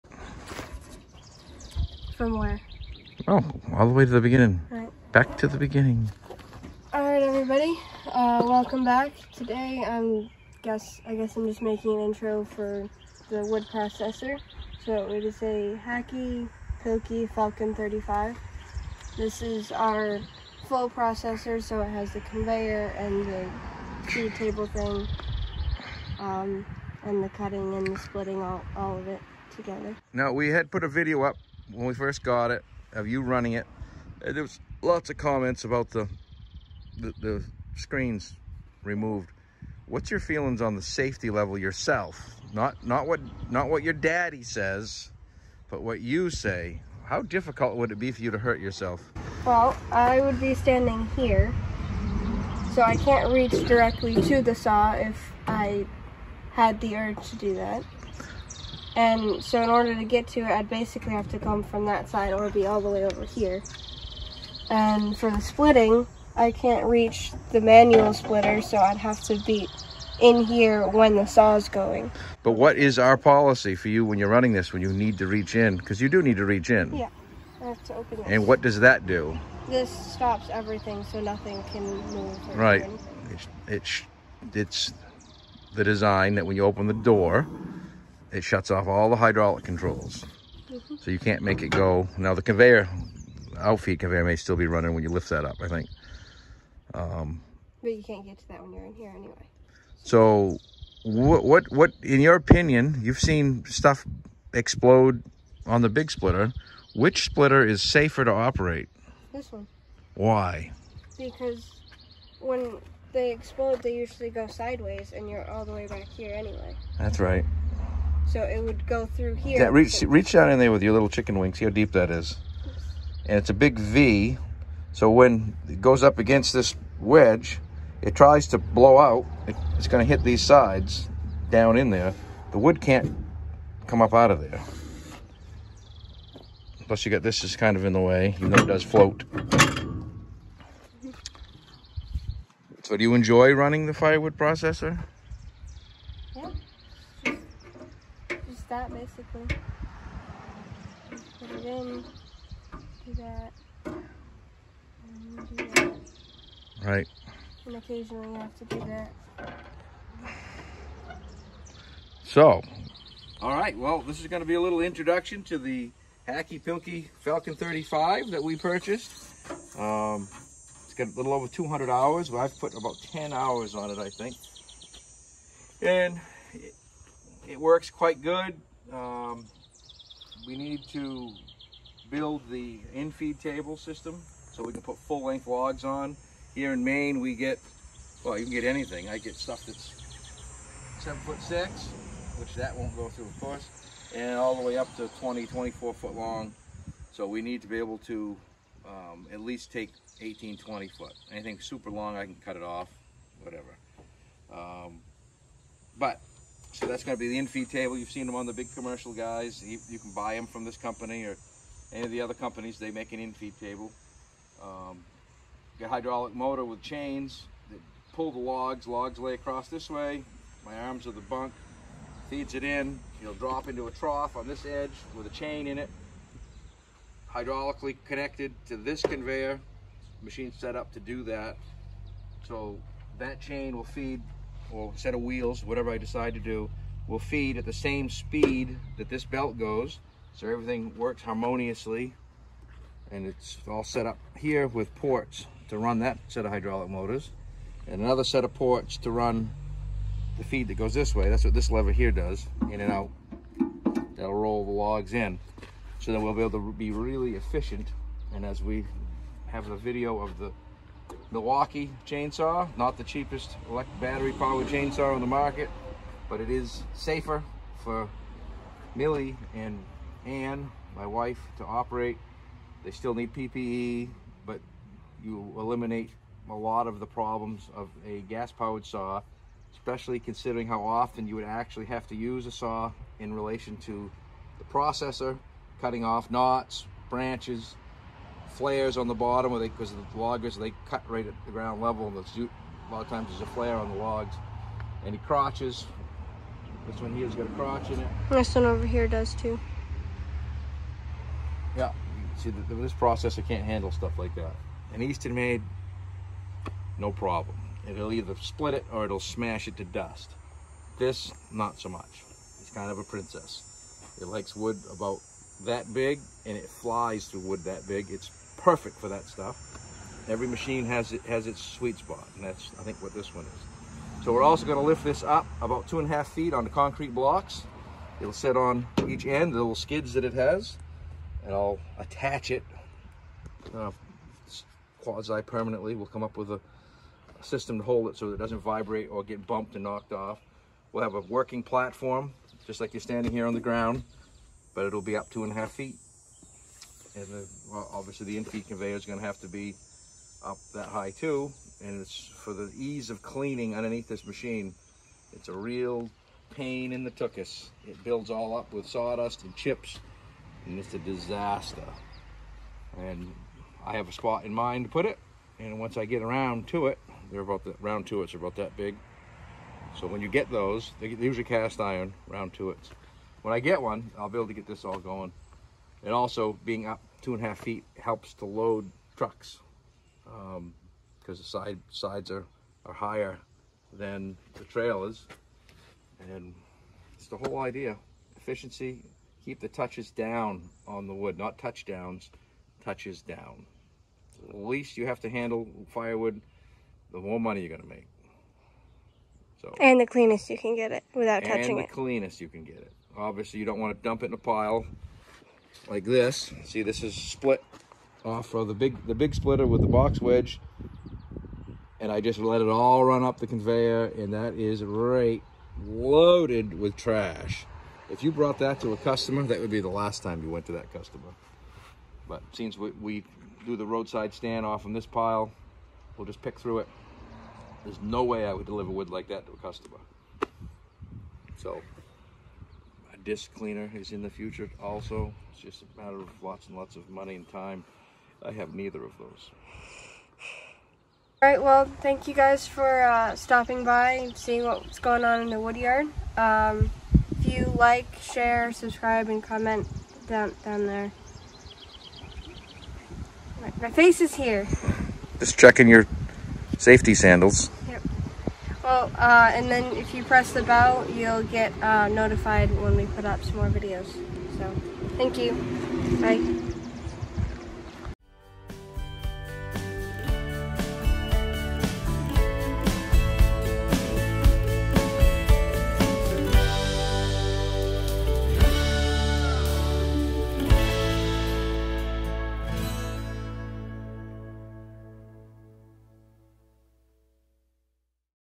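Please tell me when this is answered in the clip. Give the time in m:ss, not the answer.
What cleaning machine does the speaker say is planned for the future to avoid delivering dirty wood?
7:13.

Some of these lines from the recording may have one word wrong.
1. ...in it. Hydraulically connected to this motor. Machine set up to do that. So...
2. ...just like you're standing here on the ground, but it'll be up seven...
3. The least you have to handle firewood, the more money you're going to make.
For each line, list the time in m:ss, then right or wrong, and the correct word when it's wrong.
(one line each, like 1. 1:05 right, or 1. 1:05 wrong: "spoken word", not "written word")
1. 3:45 wrong: "conveyor", not "motor"
2. 5:42 wrong: "two", not "seven"
3. 6:34 right.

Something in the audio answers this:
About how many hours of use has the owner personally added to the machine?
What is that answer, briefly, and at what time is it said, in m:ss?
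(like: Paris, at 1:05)
10, at 2:52.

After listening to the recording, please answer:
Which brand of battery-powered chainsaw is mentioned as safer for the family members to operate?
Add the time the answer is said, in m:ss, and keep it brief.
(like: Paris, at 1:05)
Milwaukee, at 4:21.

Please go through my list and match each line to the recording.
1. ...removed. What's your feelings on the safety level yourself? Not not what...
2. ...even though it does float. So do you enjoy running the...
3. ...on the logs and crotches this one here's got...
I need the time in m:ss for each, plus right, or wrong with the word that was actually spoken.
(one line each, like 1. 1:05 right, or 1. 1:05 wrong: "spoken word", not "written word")
1. 0:38 right
2. 2:18 right
3. 4:53 right.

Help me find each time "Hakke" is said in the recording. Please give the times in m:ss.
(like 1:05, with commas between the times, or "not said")
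0:15, 2:46.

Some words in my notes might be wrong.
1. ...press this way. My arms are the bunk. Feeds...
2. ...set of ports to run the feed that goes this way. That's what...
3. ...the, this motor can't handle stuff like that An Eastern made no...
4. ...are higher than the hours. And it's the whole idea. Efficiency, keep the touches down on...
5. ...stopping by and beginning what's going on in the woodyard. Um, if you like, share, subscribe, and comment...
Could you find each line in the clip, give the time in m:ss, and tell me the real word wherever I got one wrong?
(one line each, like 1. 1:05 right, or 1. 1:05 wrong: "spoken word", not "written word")
1. 3:39 wrong: "across", not "press"
2. 4:08 right
3. 5:02 wrong: "processor", not "motor"
4. 6:22 wrong: "trailers", not "hours"
5. 7:23 wrong: "seeing", not "beginning".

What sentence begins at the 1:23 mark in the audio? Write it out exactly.
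It's, it's, it's the design that when you open the door, it shuts off all the hydraulic controls.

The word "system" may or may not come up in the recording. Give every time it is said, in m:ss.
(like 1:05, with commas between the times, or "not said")
3:03, 5:37.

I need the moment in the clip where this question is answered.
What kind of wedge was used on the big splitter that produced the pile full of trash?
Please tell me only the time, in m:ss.
6:49.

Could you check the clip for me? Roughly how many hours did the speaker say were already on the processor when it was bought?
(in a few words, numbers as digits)
a little over 200.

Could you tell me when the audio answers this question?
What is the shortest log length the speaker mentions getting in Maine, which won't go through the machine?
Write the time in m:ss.
3:10.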